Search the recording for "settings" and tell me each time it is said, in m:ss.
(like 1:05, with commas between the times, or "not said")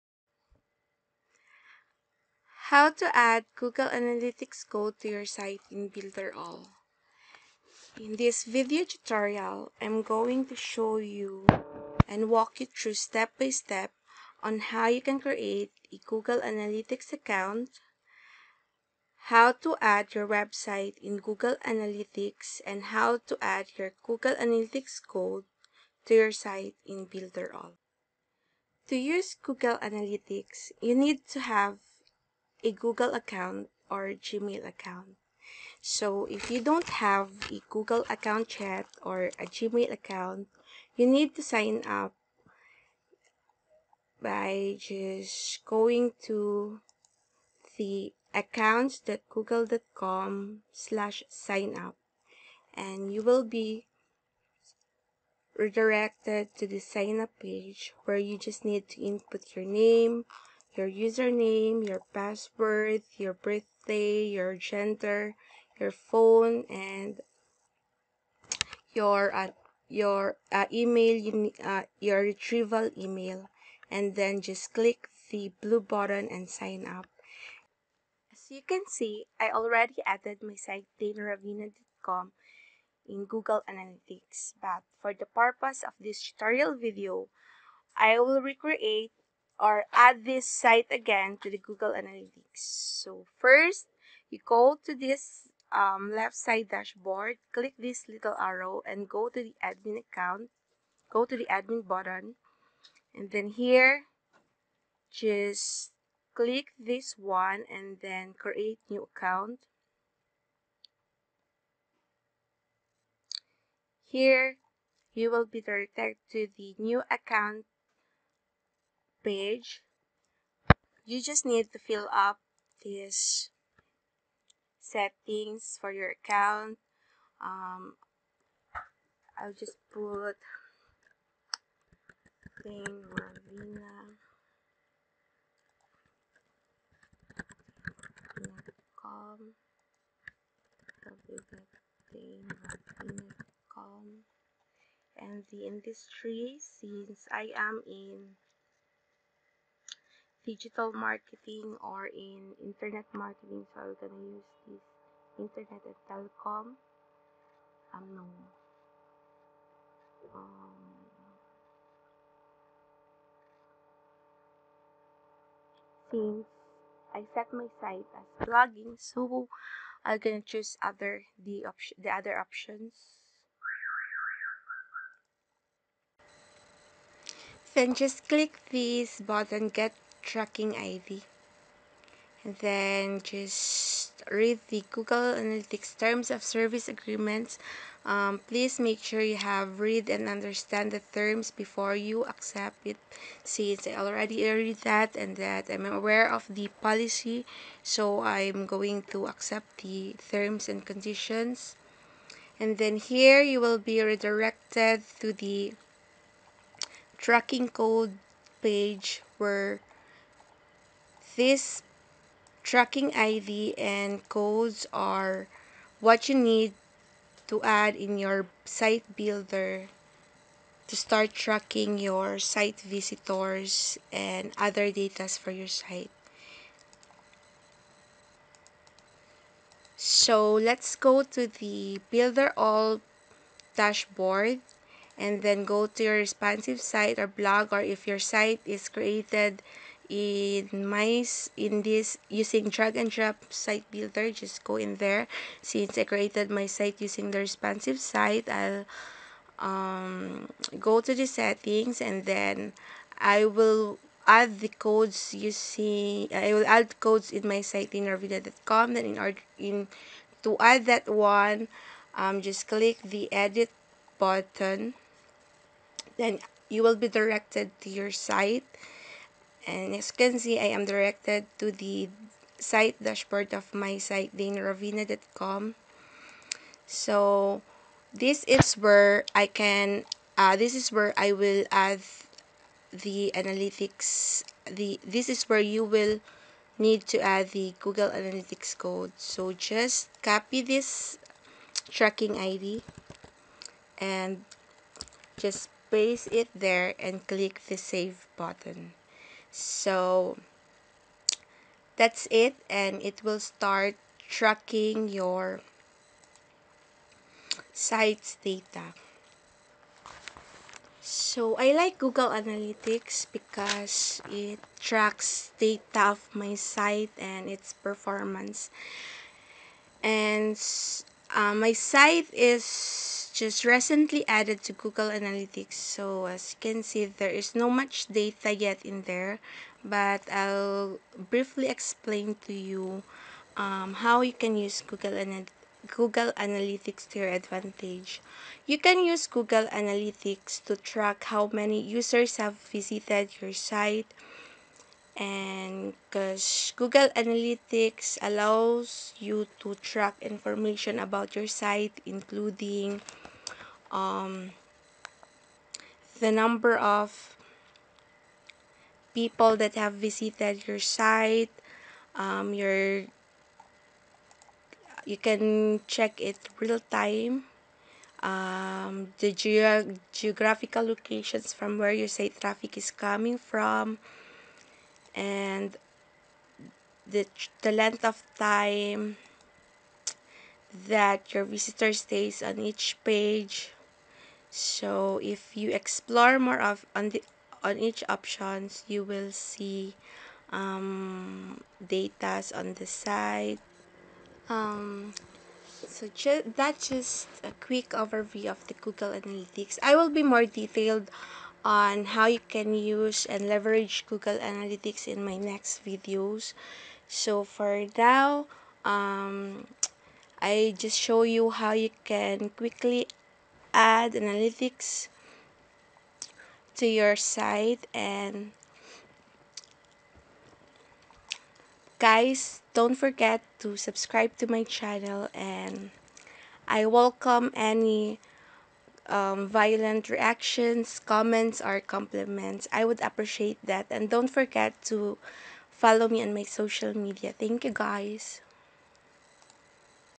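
2:04, 4:11.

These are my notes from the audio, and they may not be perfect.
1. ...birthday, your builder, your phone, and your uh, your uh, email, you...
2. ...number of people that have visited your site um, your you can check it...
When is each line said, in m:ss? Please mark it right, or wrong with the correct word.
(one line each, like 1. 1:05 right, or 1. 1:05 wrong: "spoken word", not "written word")
1. 1:03 wrong: "gender", not "builder"
2. 5:56 right.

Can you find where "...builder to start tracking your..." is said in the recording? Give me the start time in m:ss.
3:39.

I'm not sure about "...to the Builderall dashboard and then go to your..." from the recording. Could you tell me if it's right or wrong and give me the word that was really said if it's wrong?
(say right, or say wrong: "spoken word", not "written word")
right.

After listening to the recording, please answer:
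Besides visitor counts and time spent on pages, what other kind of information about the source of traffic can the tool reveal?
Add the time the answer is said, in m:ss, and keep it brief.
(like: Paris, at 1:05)
Geographical locations, at 6:10.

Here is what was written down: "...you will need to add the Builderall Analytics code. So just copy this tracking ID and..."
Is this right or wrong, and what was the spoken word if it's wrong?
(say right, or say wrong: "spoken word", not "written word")
wrong: "Google", not "Builderall".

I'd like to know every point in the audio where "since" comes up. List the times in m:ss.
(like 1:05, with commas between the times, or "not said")
2:26, 2:46, 3:13, 4:05.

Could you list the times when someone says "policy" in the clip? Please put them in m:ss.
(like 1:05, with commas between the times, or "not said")
3:16.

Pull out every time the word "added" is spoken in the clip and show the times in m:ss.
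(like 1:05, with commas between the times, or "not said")
1:20, 5:24.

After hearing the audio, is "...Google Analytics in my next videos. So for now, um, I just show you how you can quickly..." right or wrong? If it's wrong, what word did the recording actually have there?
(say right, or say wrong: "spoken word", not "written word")
right.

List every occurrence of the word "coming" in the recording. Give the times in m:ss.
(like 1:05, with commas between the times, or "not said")
6:12.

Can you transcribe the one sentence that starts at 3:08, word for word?
Um, please make sure you have read and understand the terms before you accept it.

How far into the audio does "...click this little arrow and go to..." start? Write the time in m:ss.
1:37.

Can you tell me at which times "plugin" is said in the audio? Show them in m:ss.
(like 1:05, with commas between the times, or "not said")
not said.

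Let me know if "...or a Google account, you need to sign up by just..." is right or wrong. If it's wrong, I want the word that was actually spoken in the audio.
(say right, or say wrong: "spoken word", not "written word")
wrong: "Gmail", not "Google".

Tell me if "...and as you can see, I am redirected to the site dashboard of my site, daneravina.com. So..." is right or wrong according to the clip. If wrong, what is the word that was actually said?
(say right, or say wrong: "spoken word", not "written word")
wrong: "directed", not "redirected".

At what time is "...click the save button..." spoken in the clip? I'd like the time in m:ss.
4:57.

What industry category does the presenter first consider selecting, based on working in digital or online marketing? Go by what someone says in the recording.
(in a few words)
Internet and telecom.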